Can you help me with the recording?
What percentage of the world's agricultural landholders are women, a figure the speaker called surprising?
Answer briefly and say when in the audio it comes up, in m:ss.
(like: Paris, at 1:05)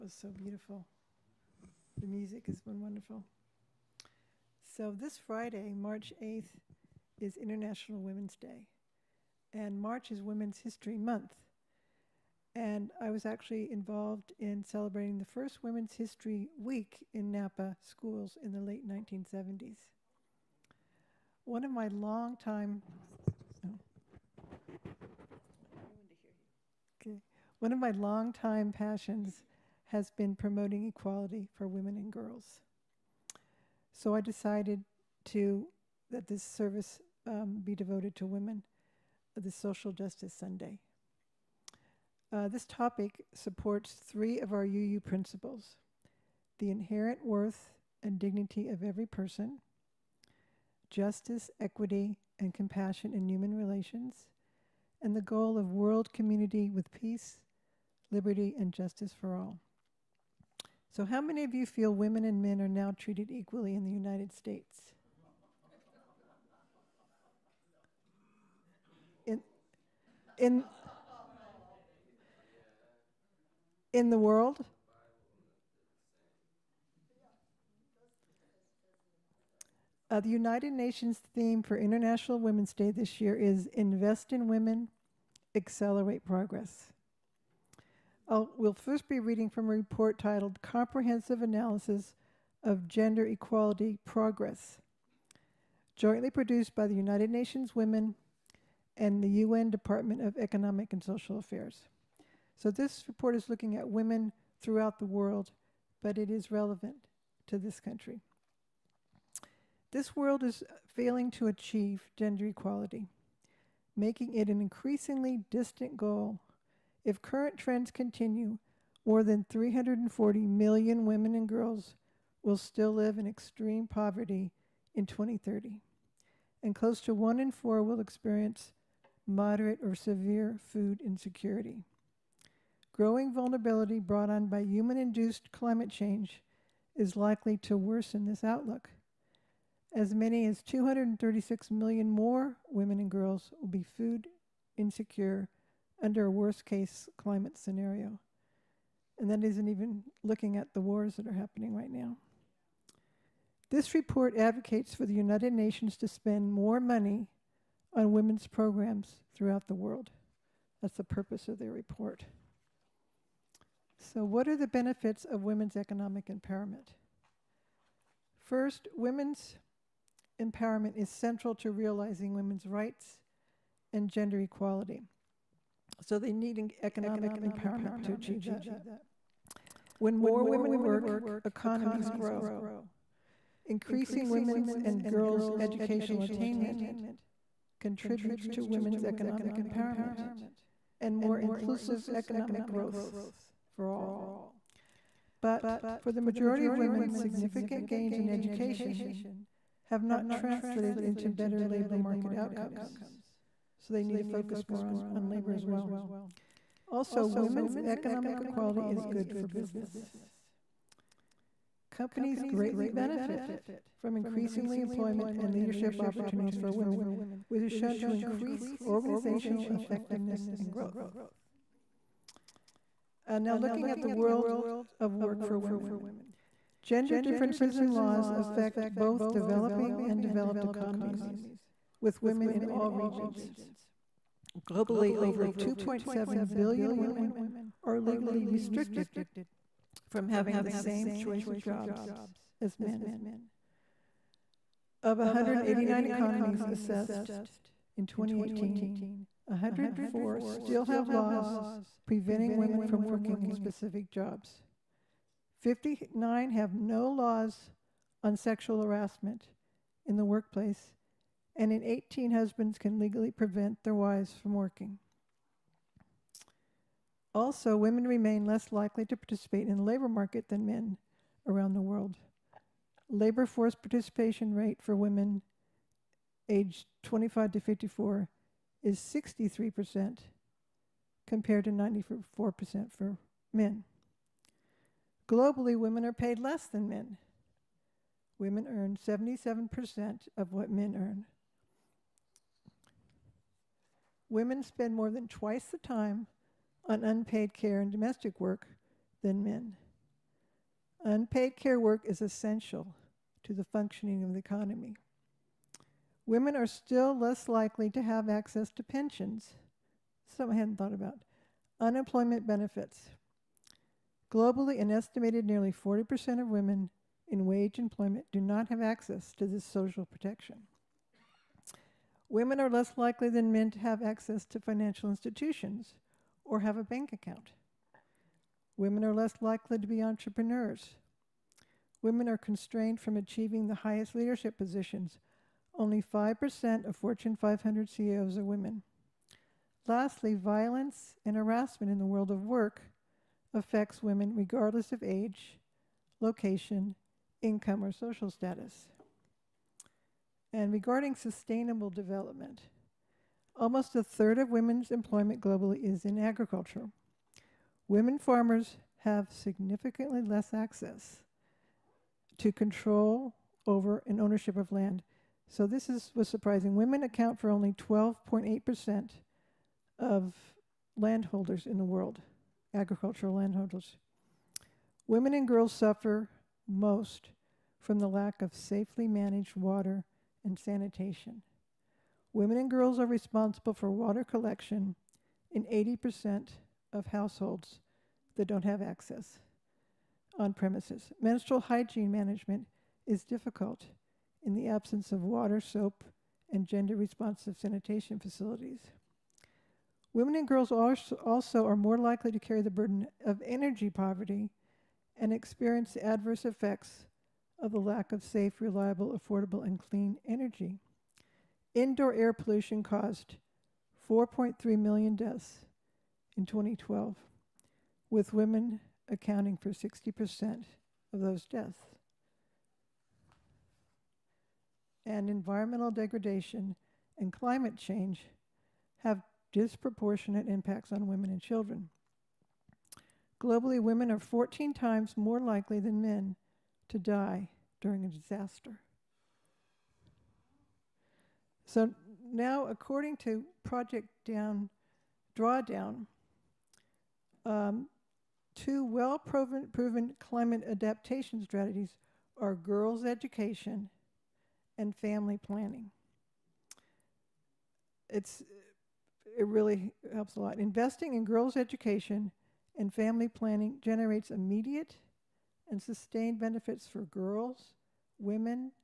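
12.8%, at 6:07.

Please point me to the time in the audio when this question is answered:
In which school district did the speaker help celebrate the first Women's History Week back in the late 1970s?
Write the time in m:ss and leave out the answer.
0:17.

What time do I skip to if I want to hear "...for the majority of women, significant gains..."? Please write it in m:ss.
3:16.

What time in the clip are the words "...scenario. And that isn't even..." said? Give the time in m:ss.
2:27.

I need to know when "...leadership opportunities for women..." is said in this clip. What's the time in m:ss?
3:35.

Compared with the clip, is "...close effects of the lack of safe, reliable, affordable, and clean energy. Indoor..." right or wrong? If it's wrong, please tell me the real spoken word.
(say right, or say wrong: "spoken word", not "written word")
wrong: "adverse", not "close".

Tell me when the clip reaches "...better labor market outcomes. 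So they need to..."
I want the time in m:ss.
3:21.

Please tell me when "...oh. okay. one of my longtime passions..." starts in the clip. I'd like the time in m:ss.
0:23.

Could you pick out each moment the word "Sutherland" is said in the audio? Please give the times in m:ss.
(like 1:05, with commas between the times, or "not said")
not said.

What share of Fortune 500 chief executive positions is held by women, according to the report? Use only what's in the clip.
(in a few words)
5%.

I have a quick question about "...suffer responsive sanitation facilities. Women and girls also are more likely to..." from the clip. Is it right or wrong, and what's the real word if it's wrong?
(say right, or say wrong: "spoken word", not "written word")
wrong: "gender", not "suffer".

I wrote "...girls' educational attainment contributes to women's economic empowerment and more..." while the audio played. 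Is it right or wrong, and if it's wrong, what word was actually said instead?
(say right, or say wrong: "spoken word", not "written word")
right.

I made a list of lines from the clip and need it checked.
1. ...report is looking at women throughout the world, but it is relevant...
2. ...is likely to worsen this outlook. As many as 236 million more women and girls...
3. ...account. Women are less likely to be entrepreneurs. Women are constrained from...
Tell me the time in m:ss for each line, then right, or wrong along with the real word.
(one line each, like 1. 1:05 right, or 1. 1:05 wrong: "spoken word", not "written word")
1. 1:43 right
2. 2:16 right
3. 5:27 right.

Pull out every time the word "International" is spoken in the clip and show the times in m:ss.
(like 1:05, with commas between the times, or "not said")
0:07, 1:21.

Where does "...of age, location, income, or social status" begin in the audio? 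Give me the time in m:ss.
5:44.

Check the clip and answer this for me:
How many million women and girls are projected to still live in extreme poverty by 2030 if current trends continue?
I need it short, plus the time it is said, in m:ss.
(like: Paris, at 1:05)
340 million, at 1:59.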